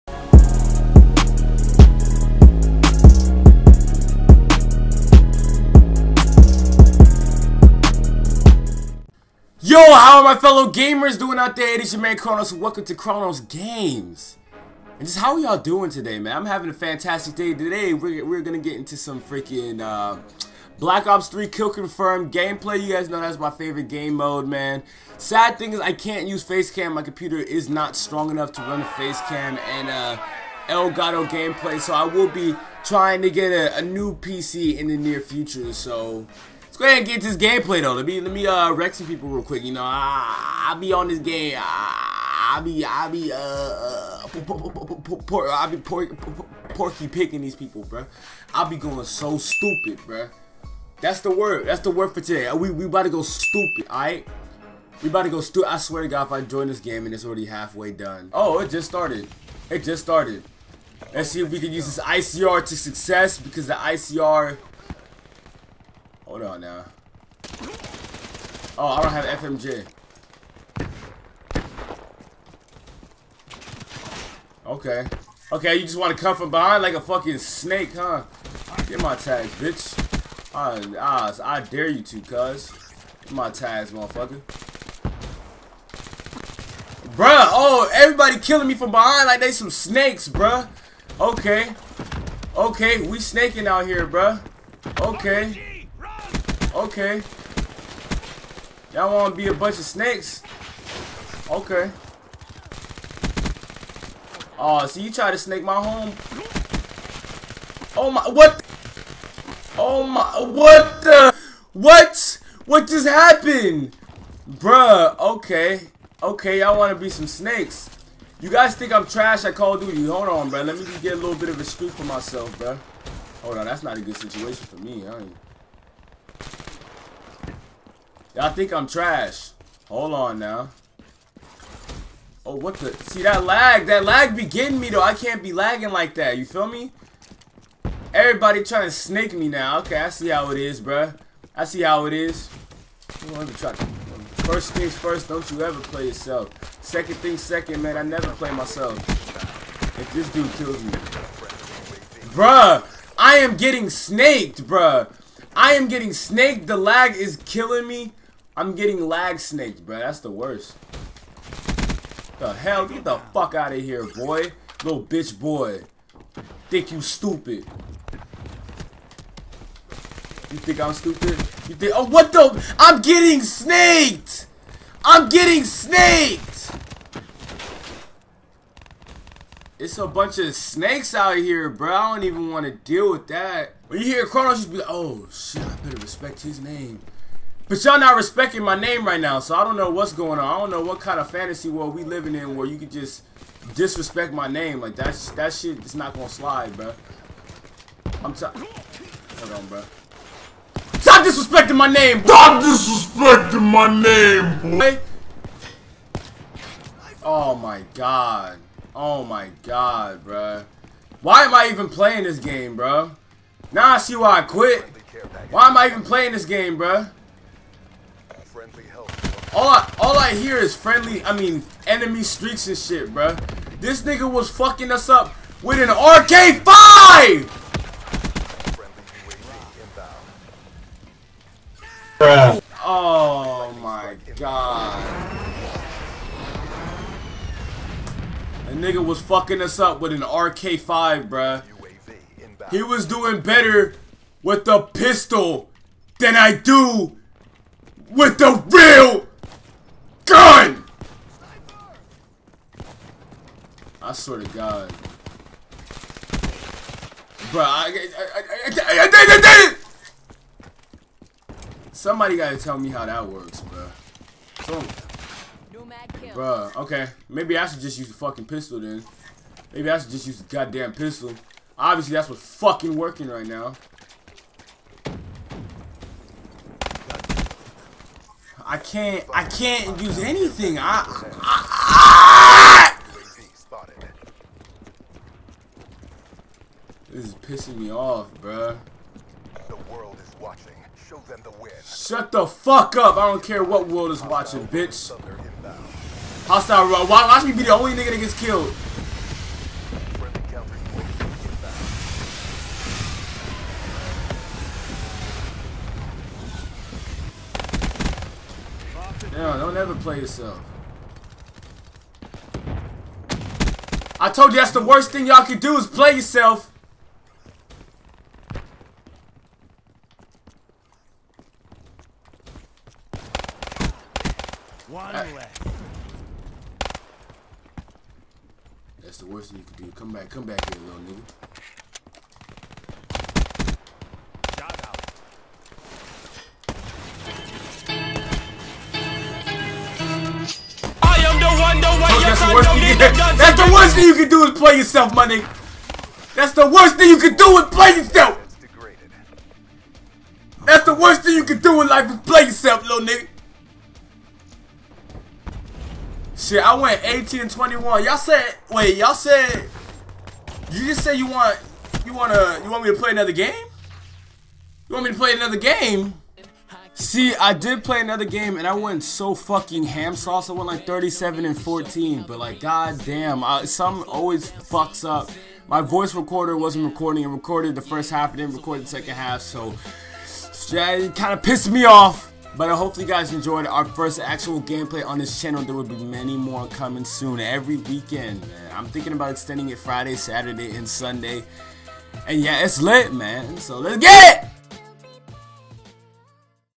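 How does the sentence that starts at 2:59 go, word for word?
It's a bunch of snakes out here, bro.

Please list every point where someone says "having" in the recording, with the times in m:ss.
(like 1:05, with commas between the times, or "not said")
0:16.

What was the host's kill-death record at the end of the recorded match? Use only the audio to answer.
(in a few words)
18 and 21.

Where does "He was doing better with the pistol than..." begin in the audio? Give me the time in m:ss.
4:02.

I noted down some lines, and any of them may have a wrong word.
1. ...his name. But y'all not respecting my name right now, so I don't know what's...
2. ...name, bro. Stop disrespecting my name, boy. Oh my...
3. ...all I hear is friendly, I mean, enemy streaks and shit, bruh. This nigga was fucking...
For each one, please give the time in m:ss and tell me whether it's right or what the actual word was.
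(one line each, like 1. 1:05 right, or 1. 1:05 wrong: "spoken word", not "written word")
1. 3:06 right
2. 3:21 right
3. 3:39 right.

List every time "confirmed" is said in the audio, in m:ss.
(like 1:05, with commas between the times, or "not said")
0:21.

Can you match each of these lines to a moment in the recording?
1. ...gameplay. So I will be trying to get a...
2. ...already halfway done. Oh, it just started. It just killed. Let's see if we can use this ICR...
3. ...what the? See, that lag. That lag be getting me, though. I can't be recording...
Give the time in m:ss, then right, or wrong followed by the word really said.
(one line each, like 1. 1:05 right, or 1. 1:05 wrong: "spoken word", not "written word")
1. 0:31 right
2. 0:57 wrong: "started", not "killed"
3. 2:12 wrong: "lagging", not "recording".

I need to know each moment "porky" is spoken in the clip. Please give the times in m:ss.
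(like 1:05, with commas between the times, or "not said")
0:46.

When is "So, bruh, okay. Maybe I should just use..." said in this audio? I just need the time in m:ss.
4:24.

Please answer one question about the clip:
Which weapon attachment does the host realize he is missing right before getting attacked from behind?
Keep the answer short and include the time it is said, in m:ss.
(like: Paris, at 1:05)
FMJ, at 1:09.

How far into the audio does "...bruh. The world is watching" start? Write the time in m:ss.
4:48.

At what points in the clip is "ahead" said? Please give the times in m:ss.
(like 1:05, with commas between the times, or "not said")
0:36.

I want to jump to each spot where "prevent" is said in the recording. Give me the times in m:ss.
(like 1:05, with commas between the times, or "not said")
not said.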